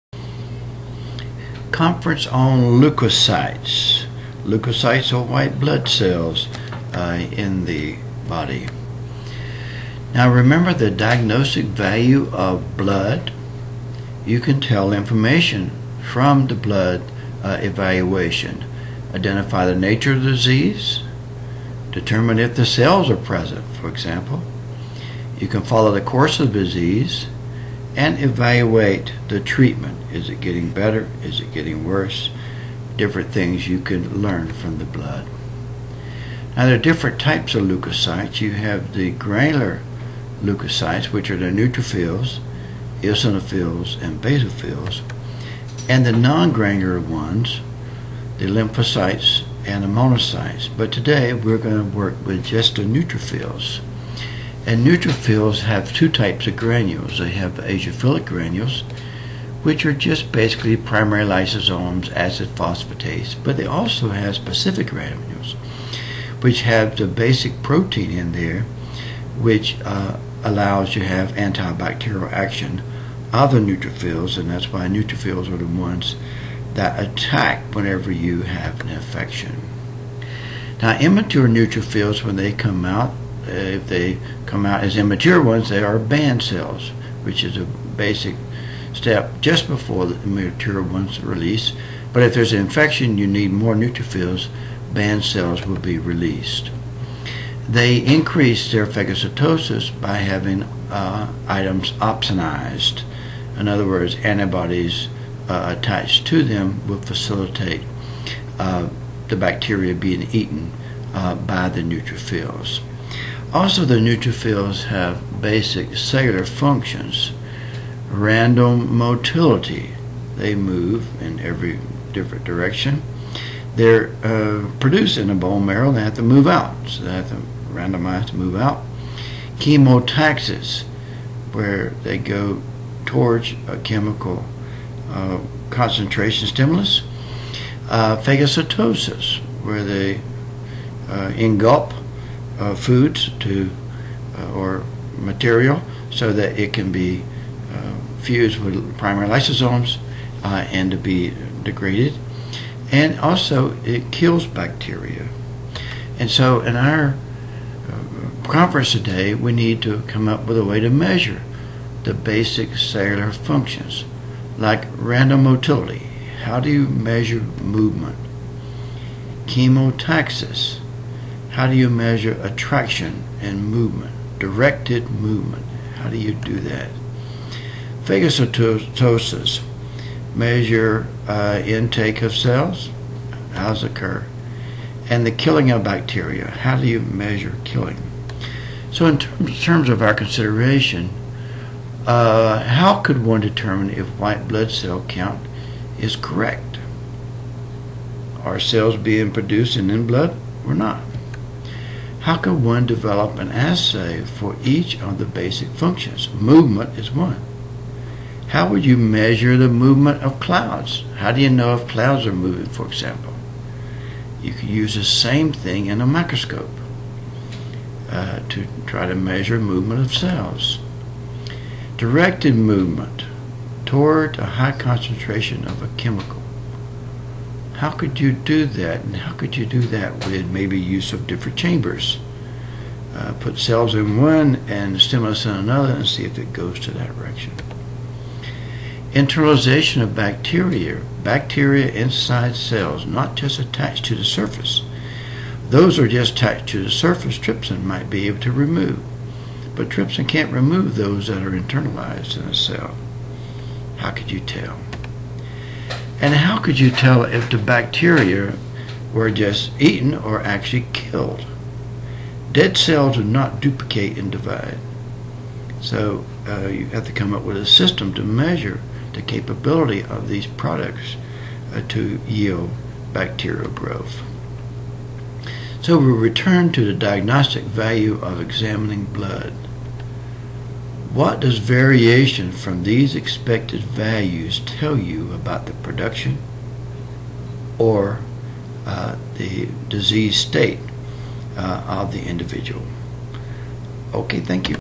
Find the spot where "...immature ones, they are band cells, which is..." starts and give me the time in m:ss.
1:24.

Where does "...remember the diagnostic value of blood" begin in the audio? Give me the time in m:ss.
0:10.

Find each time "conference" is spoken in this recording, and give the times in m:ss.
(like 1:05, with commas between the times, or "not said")
0:01, 2:38.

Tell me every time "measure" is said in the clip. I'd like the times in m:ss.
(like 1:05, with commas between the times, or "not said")
2:40, 2:46, 2:51, 3:00, 3:07, 3:28, 3:39, 4:28.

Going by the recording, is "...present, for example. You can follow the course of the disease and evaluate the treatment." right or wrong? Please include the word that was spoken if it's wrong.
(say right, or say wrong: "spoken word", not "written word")
right.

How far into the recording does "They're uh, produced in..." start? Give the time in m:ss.
2:03.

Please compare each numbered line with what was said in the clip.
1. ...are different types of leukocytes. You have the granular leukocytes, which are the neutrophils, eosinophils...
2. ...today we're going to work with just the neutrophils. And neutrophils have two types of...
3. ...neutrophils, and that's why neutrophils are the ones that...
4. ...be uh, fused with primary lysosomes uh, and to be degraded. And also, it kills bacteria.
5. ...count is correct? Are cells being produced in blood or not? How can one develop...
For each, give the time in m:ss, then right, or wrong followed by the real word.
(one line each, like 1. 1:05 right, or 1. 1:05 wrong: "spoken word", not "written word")
1. 0:36 right
2. 0:50 right
3. 1:13 right
4. 2:26 right
5. 3:15 right.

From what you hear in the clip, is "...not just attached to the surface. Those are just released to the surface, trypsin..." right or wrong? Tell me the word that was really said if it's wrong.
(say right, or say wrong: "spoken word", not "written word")
wrong: "attached", not "released".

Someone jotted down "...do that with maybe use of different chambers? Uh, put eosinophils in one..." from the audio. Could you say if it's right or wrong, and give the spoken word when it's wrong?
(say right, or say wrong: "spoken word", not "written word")
wrong: "cells", not "eosinophils".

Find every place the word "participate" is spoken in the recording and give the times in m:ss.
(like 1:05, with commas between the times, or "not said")
not said.